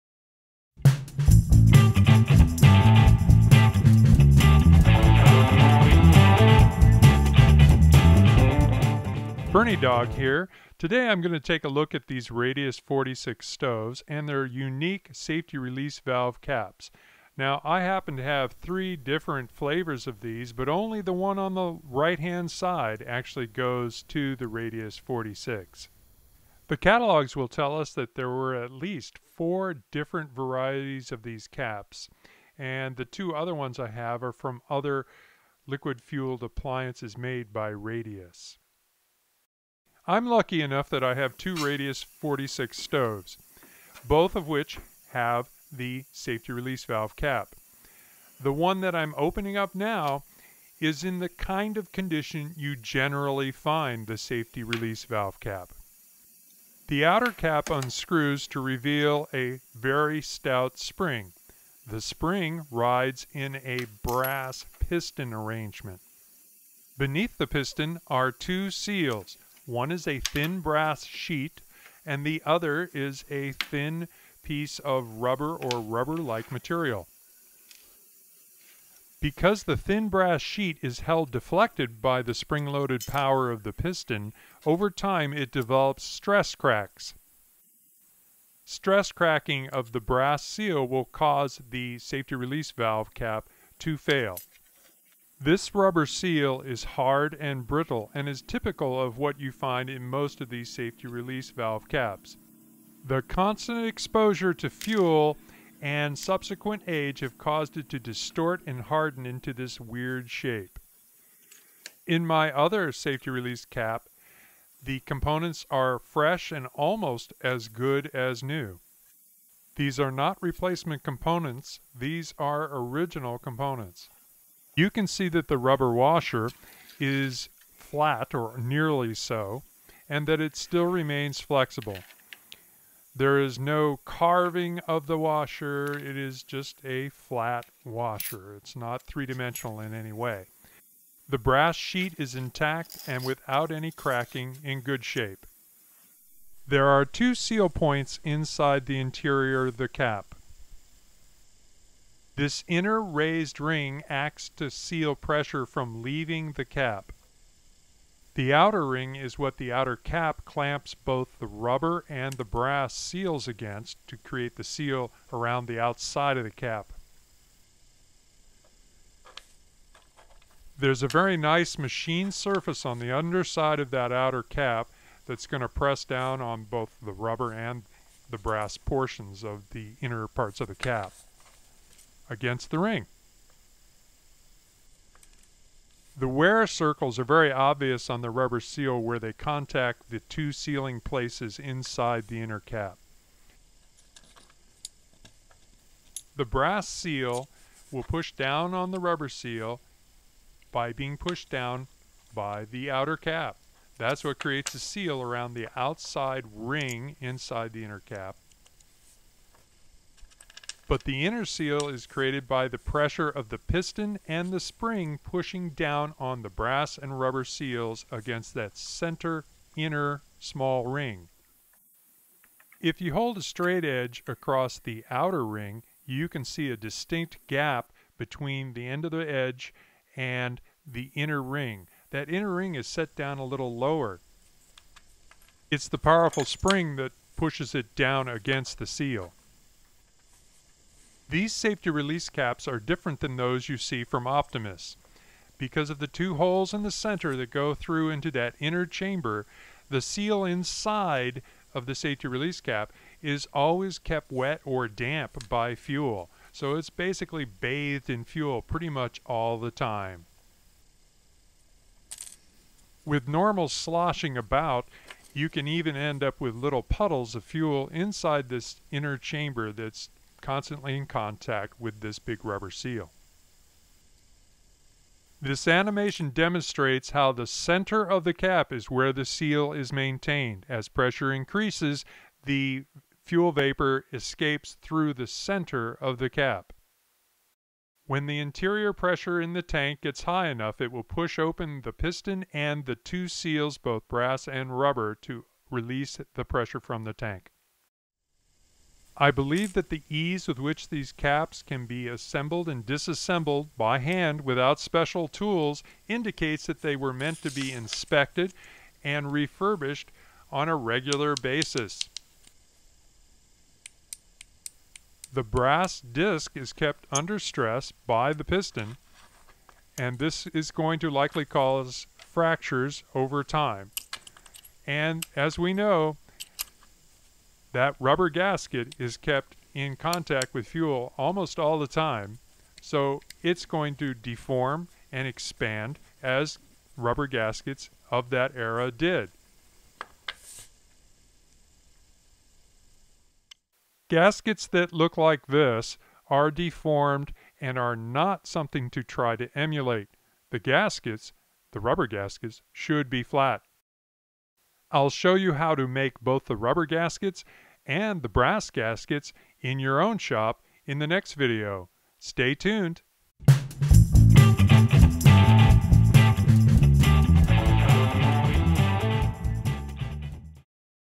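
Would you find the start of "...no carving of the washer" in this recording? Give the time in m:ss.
2:13.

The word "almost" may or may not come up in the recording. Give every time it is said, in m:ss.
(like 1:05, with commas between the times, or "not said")
1:56, 5:31.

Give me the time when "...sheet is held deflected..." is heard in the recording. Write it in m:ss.
1:20.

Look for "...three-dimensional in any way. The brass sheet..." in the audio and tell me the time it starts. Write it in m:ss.
2:19.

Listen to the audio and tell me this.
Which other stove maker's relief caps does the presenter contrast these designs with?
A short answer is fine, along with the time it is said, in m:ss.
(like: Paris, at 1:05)
Optimus, at 4:04.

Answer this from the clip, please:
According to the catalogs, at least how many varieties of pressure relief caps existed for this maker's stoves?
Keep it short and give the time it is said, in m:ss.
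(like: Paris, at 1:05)
4, at 0:29.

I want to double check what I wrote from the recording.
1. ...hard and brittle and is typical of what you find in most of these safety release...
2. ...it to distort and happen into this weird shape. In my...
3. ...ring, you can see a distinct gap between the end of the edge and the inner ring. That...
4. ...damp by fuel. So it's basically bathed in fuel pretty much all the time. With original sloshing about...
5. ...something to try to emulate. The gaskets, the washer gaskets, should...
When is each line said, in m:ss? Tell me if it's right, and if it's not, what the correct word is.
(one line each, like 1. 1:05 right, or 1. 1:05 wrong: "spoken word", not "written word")
1. 1:36 right
2. 1:47 wrong: "harden", not "happen"
3. 3:45 right
4. 4:14 wrong: "normal", not "original"
5. 5:48 wrong: "rubber", not "washer".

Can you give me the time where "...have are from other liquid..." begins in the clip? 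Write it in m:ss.
0:33.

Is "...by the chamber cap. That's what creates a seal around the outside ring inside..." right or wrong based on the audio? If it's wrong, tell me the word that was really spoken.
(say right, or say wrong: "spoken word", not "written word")
wrong: "outer", not "chamber".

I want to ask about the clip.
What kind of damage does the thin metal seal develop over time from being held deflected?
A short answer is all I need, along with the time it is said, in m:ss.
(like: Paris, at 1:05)
stress cracks, at 1:26.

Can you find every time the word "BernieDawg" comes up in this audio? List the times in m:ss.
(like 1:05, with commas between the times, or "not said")
0:09.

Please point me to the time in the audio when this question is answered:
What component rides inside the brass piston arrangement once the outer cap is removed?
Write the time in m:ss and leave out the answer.
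0:59.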